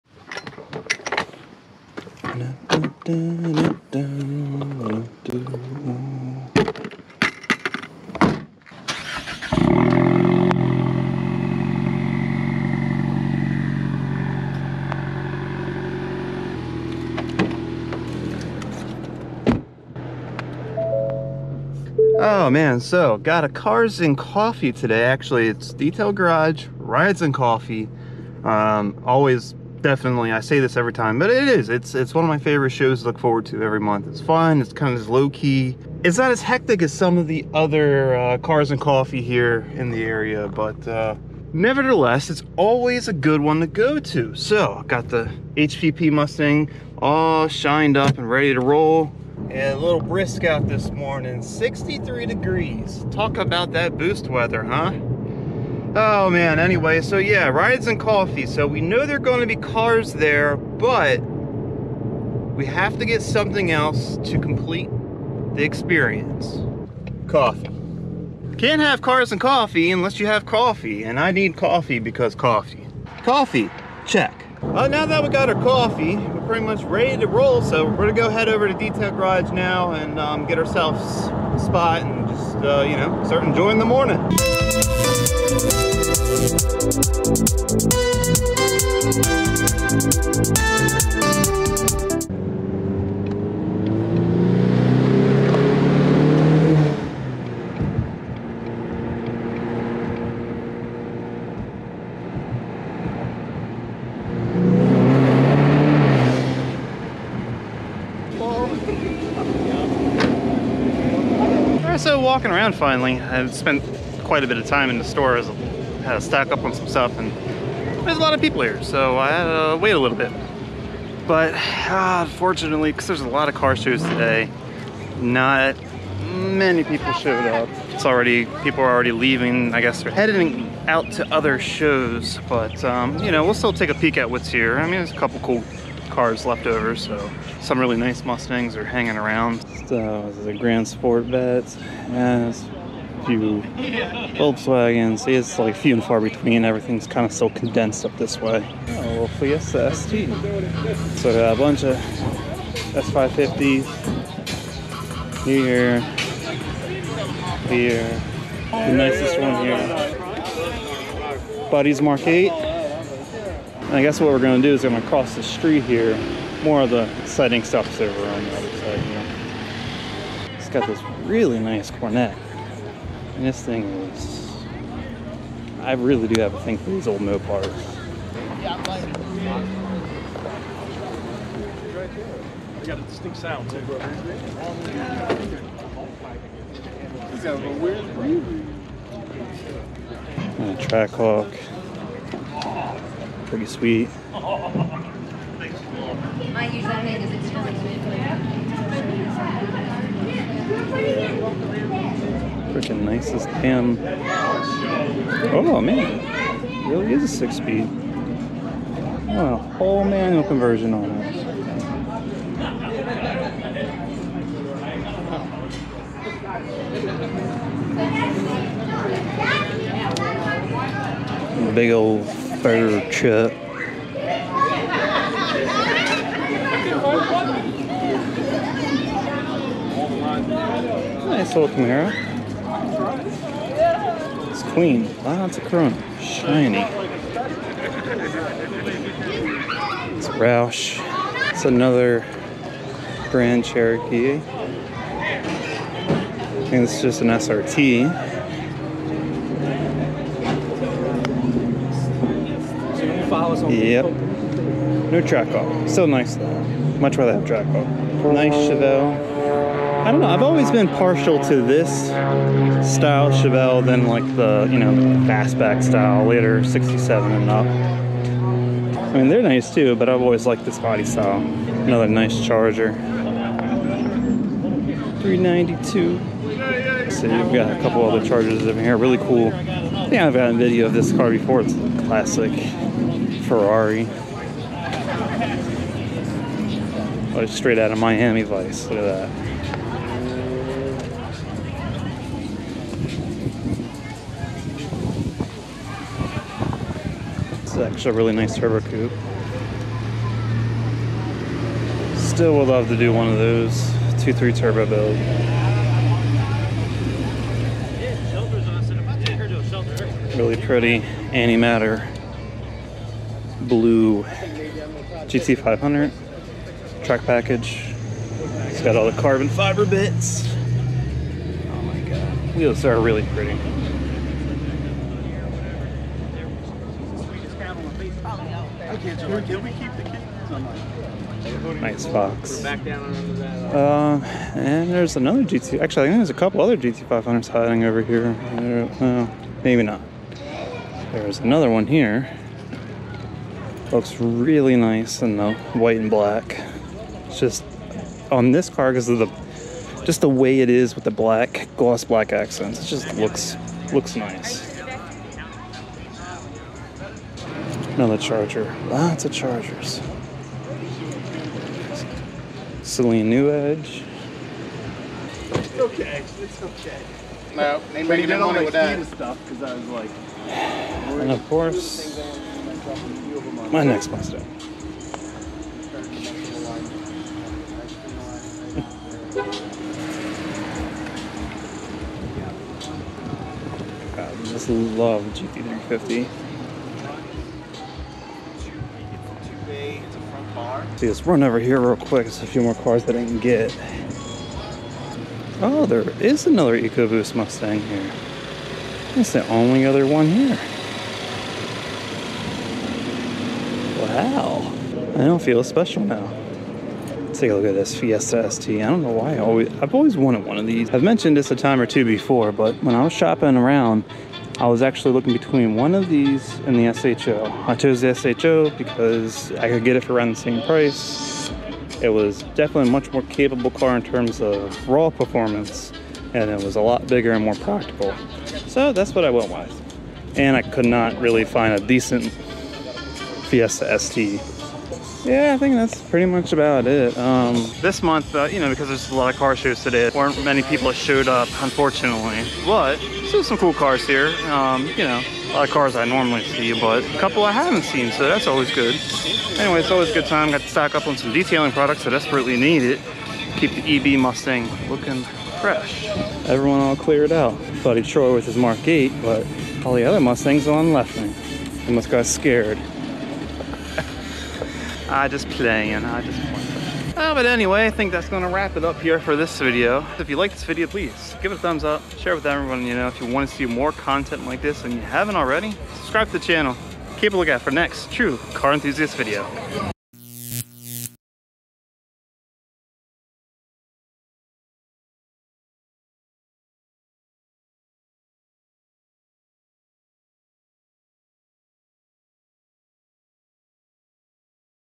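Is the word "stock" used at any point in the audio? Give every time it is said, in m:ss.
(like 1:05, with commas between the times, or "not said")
1:56, 7:30.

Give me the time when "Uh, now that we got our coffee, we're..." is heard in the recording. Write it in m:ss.
1:14.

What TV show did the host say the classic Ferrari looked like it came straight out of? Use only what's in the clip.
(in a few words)
Miami Vice.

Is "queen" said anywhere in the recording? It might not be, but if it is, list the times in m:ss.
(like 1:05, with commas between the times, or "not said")
3:54.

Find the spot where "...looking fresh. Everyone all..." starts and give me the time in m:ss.
7:34.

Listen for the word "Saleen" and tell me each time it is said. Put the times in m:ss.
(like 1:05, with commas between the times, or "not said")
6:02.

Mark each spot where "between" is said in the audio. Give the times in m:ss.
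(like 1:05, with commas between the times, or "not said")
2:26, 6:55.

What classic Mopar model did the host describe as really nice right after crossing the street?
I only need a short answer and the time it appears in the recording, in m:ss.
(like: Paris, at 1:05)
Coronet, at 2:51.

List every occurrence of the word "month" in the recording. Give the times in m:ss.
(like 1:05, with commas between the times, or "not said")
0:33, 7:18.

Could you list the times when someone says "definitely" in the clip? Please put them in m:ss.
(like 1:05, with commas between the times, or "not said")
0:29, 7:02.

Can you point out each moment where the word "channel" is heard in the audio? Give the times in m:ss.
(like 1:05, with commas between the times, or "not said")
7:56.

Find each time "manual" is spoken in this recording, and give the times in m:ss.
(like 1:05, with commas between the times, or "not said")
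3:30.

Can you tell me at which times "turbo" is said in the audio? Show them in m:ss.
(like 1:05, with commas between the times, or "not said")
4:58, 5:04.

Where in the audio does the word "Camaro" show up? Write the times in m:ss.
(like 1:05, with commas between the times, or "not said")
3:51.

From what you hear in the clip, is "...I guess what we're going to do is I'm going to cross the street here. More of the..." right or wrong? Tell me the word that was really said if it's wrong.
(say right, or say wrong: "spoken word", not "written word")
right.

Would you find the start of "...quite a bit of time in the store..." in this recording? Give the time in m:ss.
1:54.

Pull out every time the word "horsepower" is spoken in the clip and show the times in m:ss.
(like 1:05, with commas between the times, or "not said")
not said.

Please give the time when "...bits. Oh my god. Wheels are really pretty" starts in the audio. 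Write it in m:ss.
5:19.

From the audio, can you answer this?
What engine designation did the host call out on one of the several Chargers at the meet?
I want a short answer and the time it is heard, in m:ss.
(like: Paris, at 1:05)
392, at 4:35.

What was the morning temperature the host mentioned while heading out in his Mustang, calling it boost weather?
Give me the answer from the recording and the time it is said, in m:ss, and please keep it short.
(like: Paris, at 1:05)
63 degrees, at 0:51.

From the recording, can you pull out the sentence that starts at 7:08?
So that's what I went with.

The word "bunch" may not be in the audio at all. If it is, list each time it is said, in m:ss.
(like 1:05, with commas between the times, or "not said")
2:31.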